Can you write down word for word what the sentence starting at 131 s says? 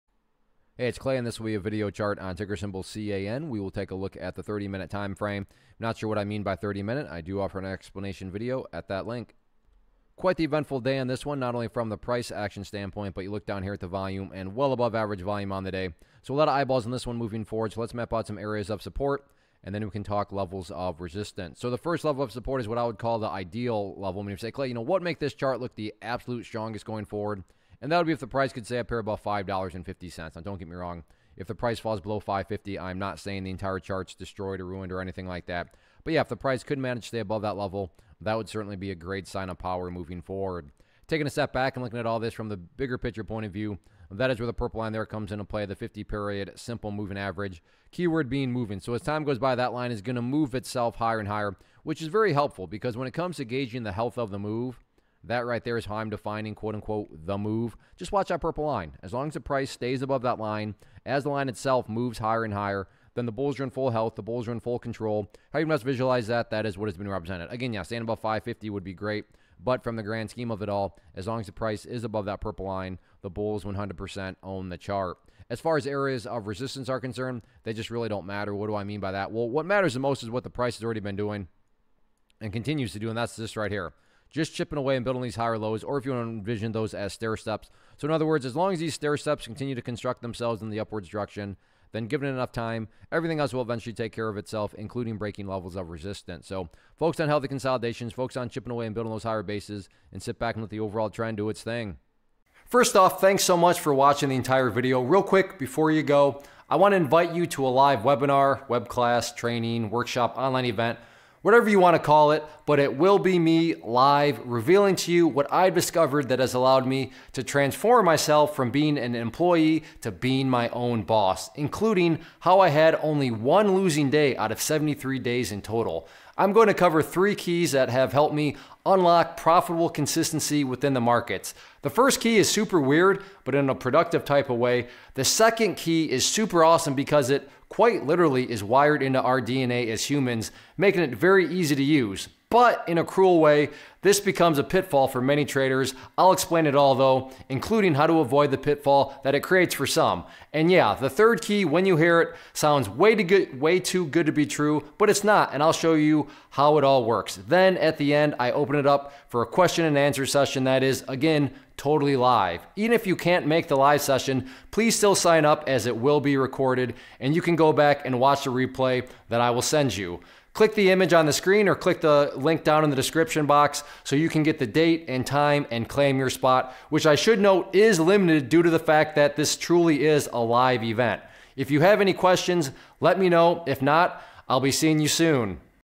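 The first key is super weird, but in a productive type of way.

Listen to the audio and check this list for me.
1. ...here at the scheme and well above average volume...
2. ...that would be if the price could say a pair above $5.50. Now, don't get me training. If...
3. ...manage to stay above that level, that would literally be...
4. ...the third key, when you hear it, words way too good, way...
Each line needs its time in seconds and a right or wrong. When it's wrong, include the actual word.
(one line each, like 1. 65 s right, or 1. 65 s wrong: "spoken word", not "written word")
1. 13 s wrong: "volume", not "scheme"
2. 27 s wrong: "wrong", not "training"
3. 36 s wrong: "certainly", not "literally"
4. 150 s wrong: "sounds", not "words".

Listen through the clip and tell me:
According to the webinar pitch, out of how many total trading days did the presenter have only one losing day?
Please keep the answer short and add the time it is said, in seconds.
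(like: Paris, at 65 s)
73, at 124 s.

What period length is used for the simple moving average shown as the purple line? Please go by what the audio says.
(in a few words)
50.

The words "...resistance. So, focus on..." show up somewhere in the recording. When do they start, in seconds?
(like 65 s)
95 s.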